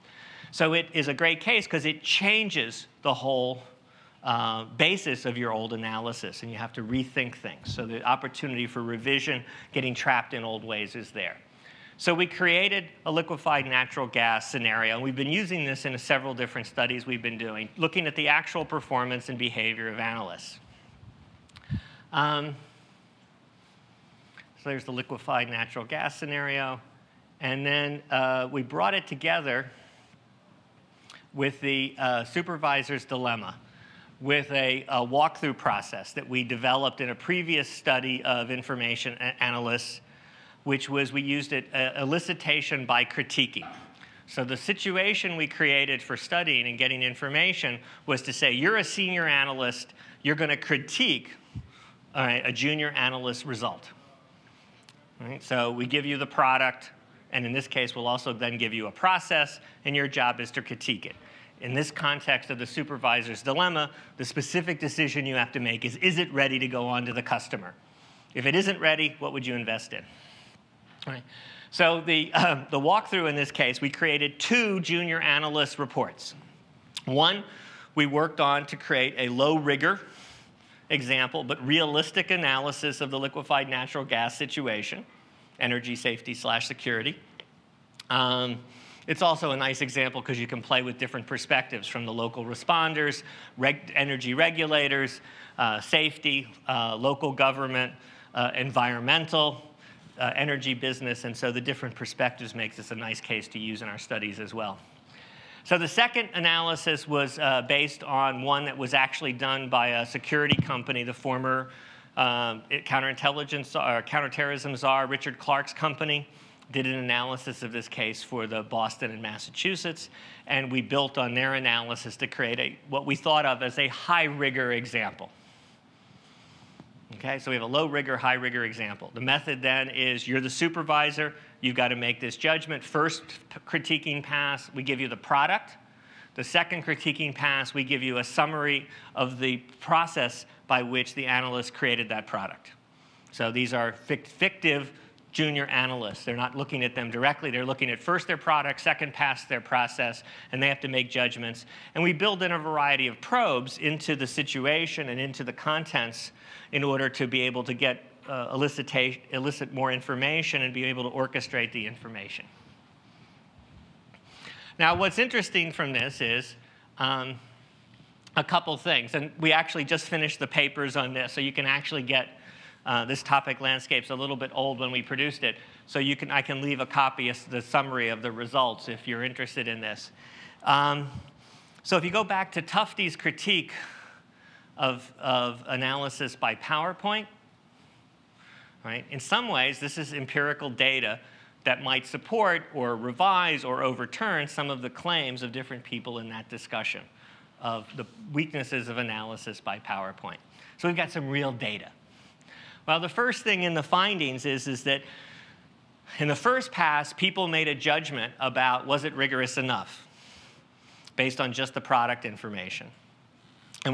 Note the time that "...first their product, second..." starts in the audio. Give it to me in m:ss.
2:28.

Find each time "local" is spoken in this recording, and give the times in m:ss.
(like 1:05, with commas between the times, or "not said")
1:32, 1:36.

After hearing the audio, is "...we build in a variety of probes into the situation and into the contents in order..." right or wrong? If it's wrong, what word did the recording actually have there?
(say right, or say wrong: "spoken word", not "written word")
right.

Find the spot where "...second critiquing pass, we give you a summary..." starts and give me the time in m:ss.
2:16.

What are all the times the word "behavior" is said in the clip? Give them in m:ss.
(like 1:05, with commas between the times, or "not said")
0:19.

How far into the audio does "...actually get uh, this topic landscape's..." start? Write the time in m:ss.
2:51.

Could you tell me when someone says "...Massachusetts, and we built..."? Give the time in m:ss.
1:59.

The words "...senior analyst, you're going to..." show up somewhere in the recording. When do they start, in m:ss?
0:48.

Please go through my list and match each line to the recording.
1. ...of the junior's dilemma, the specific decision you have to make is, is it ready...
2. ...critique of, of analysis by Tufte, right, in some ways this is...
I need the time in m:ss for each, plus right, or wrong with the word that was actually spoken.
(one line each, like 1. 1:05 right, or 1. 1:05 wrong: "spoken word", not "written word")
1. 1:02 wrong: "supervisor", not "junior"
2. 3:03 wrong: "PowerPoint", not "Tufte".